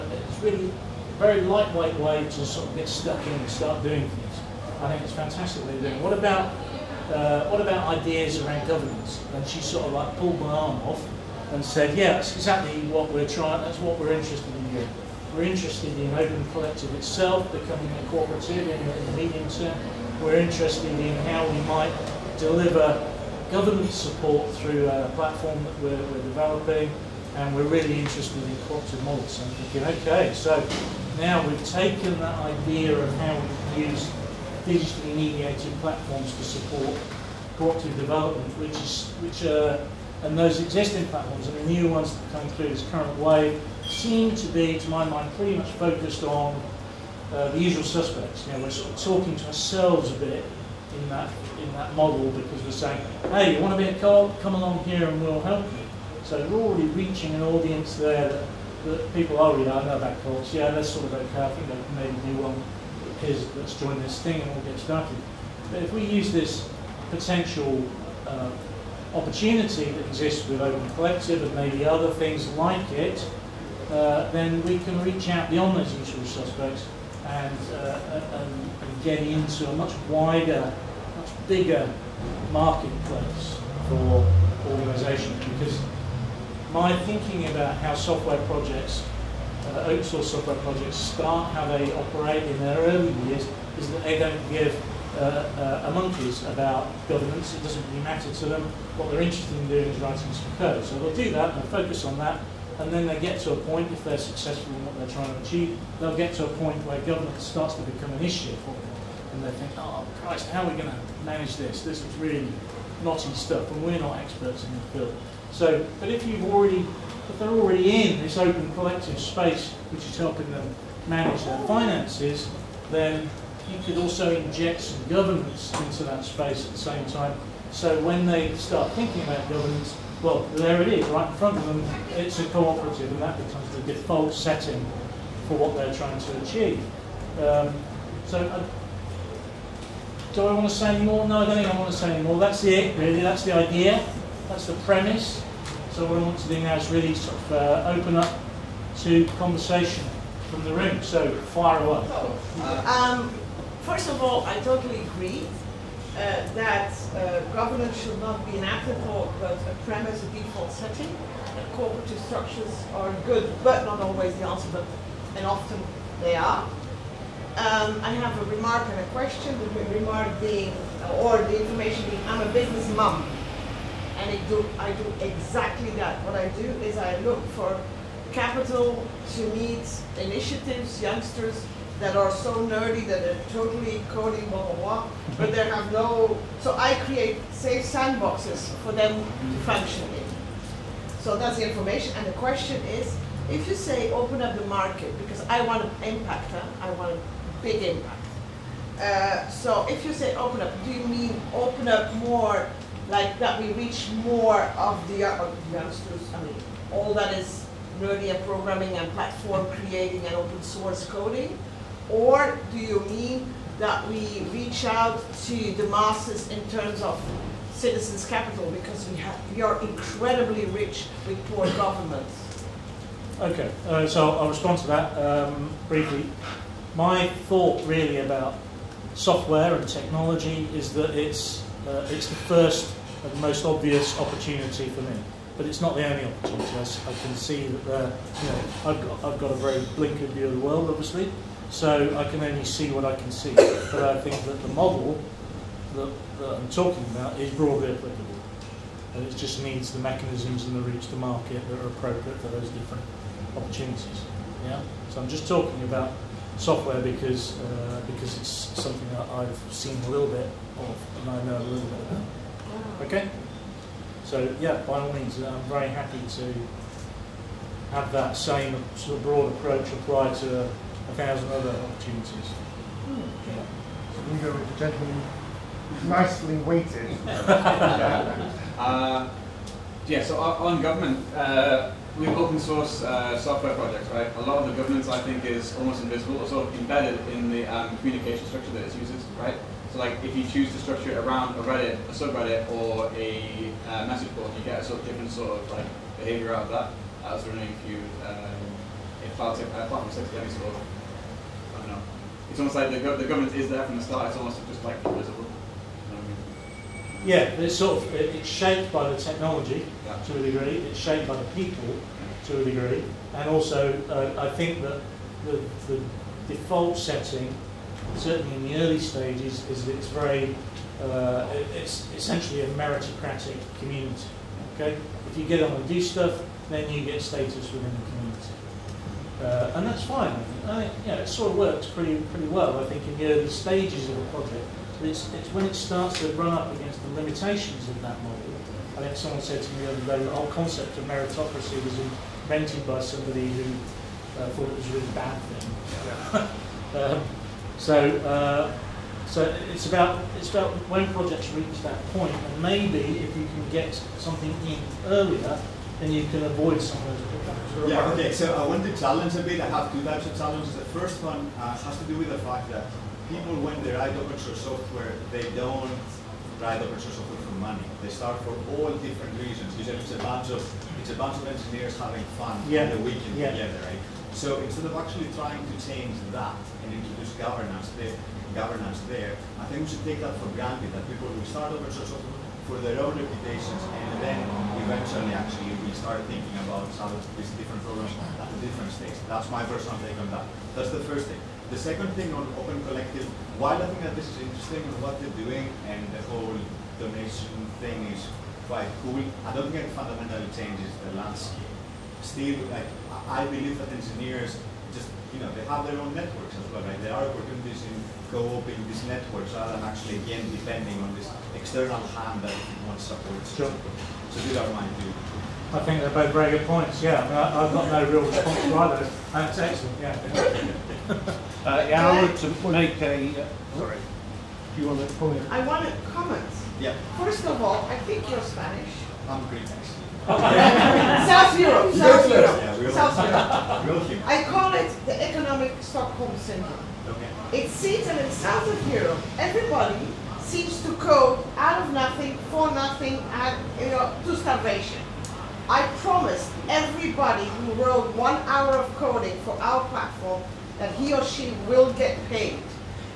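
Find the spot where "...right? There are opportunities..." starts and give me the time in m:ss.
6:46.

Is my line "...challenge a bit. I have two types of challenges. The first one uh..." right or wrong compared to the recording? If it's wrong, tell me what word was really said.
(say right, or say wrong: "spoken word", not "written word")
right.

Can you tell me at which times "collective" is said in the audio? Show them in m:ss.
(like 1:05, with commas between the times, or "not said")
0:16, 1:10, 1:58, 6:32.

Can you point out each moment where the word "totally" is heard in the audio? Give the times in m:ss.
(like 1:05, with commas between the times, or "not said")
2:34, 3:03.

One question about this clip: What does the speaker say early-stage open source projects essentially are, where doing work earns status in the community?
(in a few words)
meritocratic community.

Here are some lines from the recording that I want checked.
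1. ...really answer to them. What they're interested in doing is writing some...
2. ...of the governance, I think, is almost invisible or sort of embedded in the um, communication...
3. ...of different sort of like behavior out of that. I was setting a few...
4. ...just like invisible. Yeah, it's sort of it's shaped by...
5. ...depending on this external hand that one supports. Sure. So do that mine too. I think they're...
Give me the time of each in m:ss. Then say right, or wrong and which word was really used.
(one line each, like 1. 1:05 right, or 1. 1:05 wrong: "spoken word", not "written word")
1. 1:37 wrong: "matter", not "answer"
2. 4:44 right
3. 4:55 wrong: "running", not "setting"
4. 5:04 right
5. 6:50 right.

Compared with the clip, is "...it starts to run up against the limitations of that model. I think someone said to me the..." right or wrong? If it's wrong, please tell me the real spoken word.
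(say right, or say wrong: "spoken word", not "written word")
right.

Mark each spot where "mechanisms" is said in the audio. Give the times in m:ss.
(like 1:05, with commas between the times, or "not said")
4:10.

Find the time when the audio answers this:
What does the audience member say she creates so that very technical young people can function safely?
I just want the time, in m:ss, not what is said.
3:07.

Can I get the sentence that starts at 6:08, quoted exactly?
They start for all different reasons.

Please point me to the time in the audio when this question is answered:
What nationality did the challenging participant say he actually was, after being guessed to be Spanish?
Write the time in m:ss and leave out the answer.
7:09.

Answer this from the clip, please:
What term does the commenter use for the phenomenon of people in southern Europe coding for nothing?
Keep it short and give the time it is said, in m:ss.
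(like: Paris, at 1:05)
economic Stockholm syndrome, at 7:15.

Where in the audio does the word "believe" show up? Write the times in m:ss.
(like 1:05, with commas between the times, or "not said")
6:43.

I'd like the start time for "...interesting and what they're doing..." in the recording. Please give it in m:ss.
6:34.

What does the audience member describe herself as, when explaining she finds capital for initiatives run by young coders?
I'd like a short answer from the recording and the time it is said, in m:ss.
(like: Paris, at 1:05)
business mom, at 2:52.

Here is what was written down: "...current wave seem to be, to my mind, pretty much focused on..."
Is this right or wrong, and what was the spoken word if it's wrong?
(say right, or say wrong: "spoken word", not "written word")
right.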